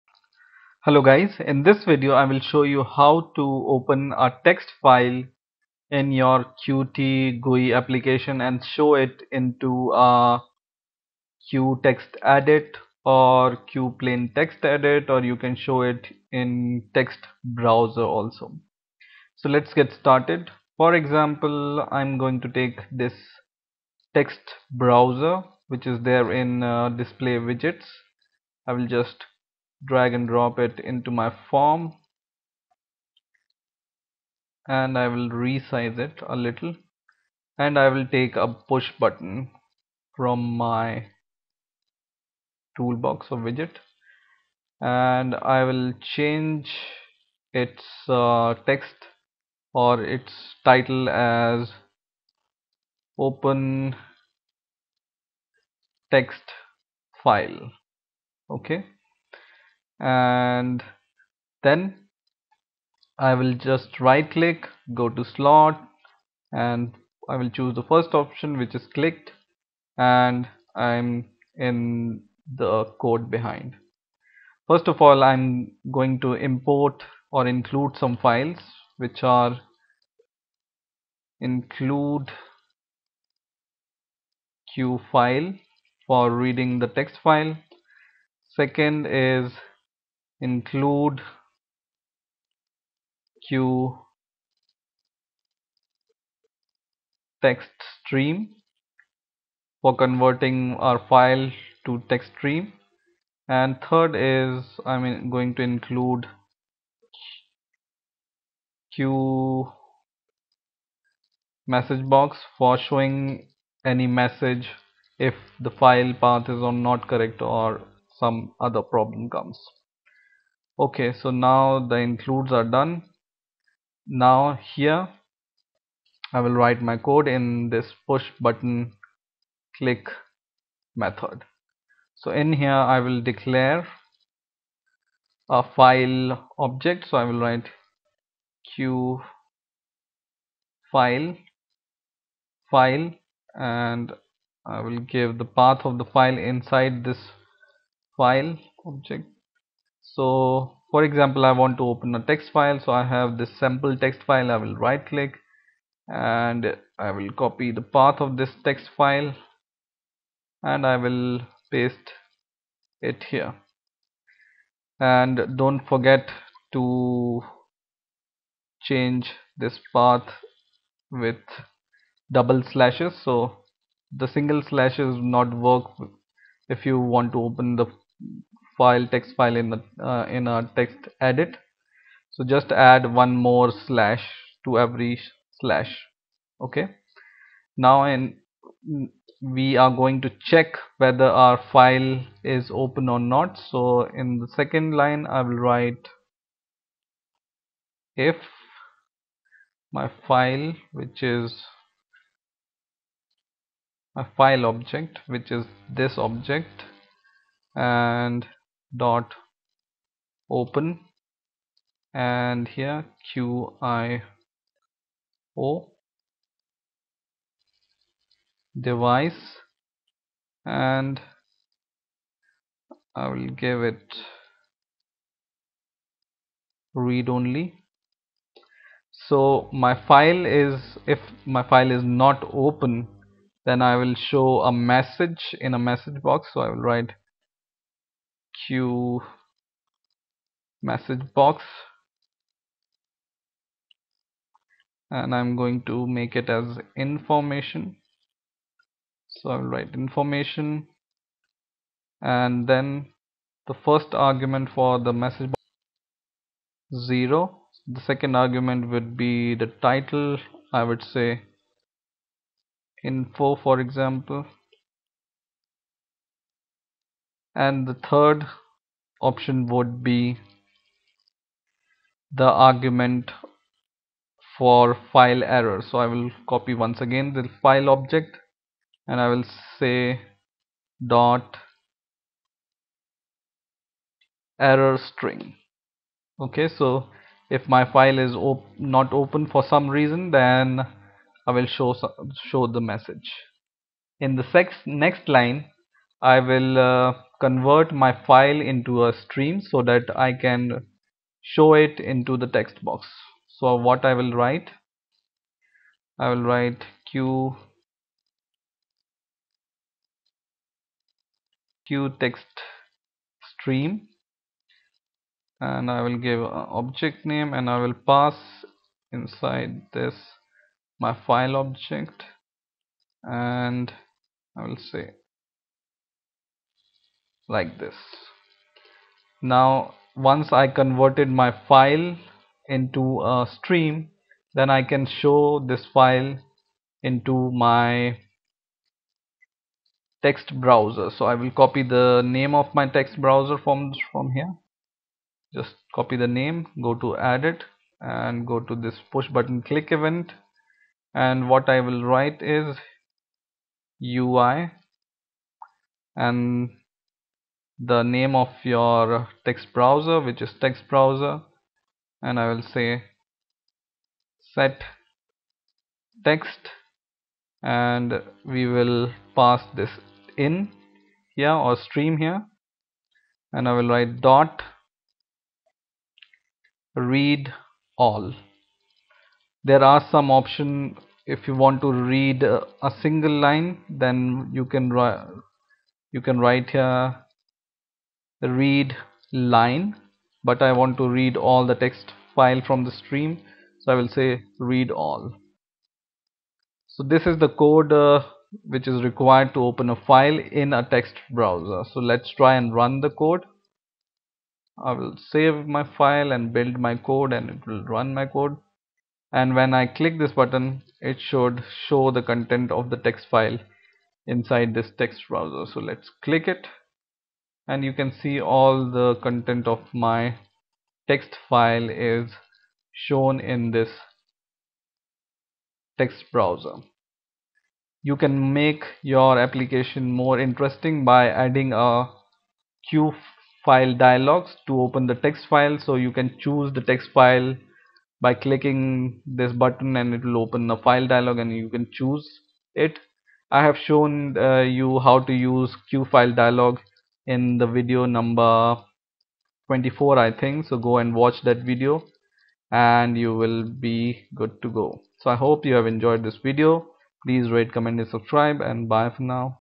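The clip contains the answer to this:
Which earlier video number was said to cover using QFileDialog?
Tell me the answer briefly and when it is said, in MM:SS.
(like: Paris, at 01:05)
24, at 07:29.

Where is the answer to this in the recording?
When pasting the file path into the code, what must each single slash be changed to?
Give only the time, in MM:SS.
02:52.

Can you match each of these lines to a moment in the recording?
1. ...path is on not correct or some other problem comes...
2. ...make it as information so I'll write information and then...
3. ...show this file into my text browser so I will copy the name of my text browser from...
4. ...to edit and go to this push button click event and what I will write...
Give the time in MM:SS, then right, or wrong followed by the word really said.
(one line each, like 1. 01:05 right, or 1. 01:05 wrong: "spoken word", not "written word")
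1. 01:56 right
2. 04:06 right
3. 05:35 right
4. 05:46 right.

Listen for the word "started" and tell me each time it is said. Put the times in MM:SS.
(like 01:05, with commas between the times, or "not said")
00:19.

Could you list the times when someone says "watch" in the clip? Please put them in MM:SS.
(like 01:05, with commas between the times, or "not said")
07:31.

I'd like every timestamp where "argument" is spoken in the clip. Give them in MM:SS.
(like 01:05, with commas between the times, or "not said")
04:14, 04:18, 04:32.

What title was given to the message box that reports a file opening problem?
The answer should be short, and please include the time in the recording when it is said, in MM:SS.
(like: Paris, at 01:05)
Info, at 04:23.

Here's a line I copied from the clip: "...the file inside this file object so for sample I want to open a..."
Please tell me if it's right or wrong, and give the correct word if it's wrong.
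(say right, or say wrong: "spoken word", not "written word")
wrong: "example", not "sample".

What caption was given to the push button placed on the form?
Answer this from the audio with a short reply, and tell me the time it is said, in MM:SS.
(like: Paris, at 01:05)
Open text file, at 00:53.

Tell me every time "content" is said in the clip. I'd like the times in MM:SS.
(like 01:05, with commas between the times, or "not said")
06:52, 06:59.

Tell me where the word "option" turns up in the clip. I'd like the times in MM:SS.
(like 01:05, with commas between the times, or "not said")
01:08, 04:29, 06:20.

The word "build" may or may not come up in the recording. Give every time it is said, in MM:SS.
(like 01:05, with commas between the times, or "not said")
06:46.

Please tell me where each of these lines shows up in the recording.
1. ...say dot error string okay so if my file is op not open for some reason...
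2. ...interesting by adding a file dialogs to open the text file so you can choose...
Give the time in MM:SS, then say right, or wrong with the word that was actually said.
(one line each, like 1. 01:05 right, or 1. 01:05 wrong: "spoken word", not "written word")
1. 04:39 right
2. 07:10 right.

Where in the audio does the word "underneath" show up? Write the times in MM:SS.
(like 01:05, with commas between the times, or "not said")
not said.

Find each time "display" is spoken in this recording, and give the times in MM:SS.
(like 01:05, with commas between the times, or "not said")
00:26.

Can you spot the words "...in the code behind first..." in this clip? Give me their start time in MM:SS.
01:11.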